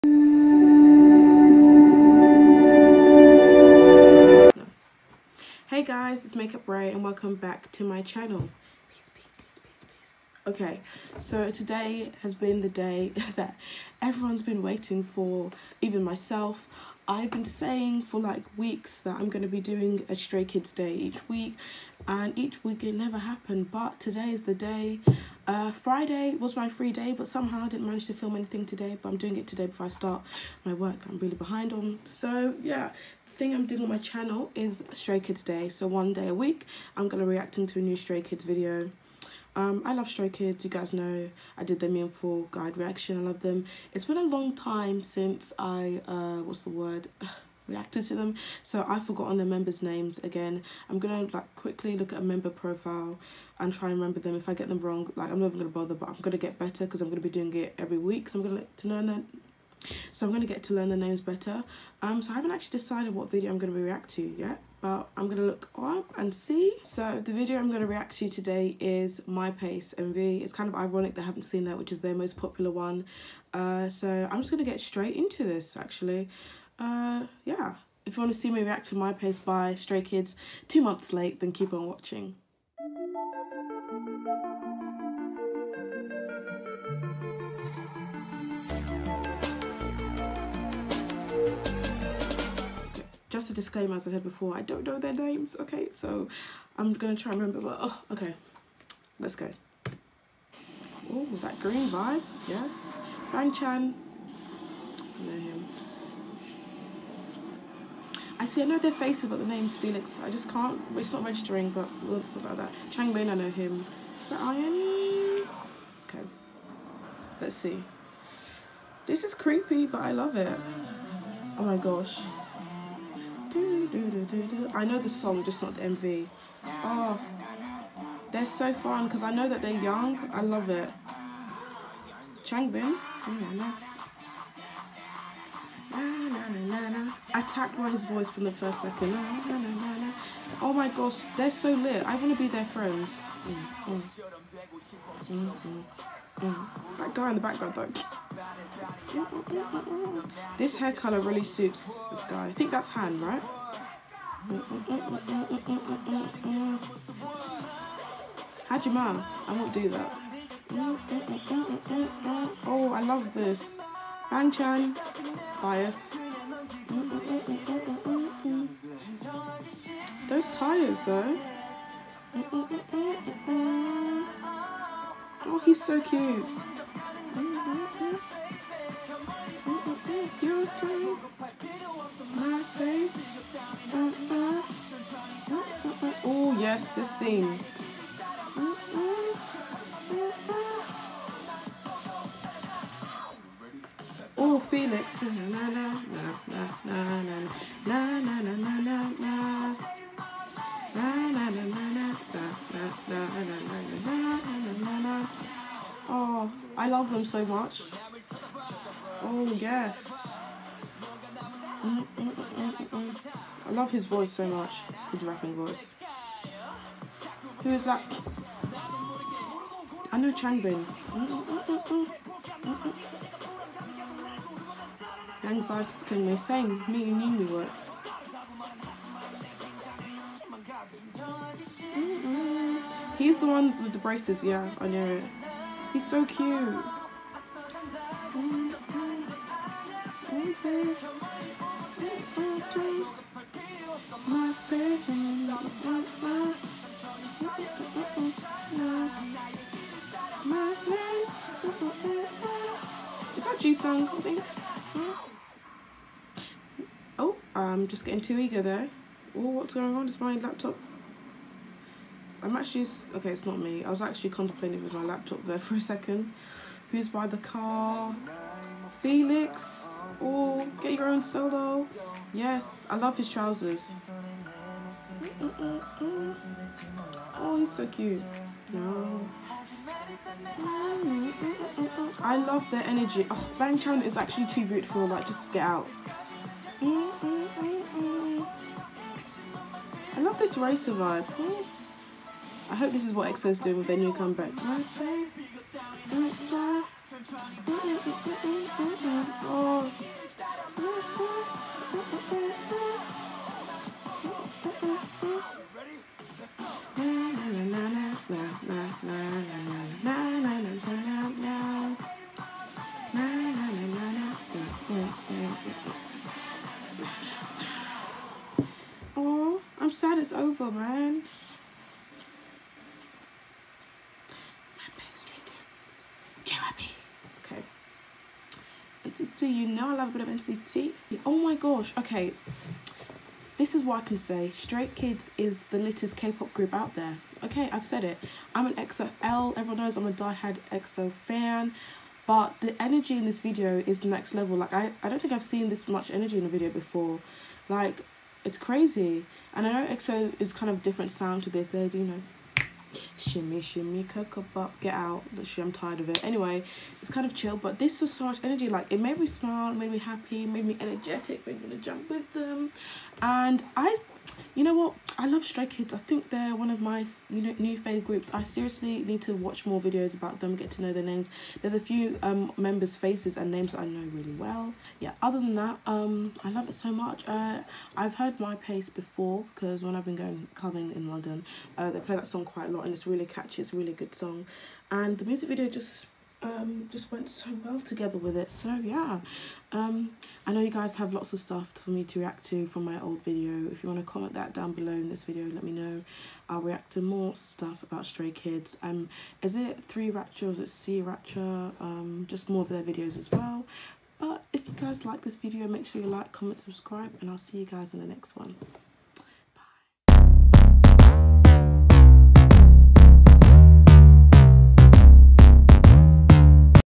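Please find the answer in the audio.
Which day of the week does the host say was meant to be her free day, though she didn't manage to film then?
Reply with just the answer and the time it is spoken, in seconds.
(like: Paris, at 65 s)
Friday, at 25 s.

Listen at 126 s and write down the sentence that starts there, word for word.
Oh, they're so fun because I know that they're young.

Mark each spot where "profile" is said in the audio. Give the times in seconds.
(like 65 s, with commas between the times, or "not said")
52 s.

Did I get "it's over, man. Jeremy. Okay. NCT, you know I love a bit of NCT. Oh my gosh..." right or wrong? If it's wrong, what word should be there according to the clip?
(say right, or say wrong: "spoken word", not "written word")
right.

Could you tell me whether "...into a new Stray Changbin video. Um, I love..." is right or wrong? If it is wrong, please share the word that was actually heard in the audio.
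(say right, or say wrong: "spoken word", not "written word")
wrong: "Kids", not "Changbin".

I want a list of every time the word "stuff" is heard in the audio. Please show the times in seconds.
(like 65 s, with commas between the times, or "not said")
391 s, 397 s.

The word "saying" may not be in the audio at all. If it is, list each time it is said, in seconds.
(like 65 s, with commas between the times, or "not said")
17 s, 226 s.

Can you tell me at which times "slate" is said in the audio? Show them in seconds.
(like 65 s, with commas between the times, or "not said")
not said.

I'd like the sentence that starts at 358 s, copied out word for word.
Like, it made me smile, made me happy, made me energetic, made me want to jump with them.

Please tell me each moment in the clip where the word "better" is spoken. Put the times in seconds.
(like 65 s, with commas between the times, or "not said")
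56 s, 61 s.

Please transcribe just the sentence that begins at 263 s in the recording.
I was actually contemplating with my laptop there for a second.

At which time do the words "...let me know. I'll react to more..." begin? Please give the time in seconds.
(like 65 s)
395 s.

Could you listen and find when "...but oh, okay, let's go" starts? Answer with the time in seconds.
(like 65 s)
97 s.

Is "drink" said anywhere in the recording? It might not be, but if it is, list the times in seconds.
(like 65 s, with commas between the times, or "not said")
not said.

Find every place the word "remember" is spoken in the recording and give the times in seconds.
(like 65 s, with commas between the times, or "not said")
53 s, 97 s.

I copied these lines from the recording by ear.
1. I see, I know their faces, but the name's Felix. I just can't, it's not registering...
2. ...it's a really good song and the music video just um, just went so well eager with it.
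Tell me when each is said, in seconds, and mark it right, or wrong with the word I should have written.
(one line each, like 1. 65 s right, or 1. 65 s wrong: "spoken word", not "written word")
1. 108 s right
2. 383 s wrong: "together", not "eager".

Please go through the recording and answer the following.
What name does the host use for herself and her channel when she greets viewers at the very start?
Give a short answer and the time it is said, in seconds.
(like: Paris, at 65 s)
MakeupRai, at 6 s.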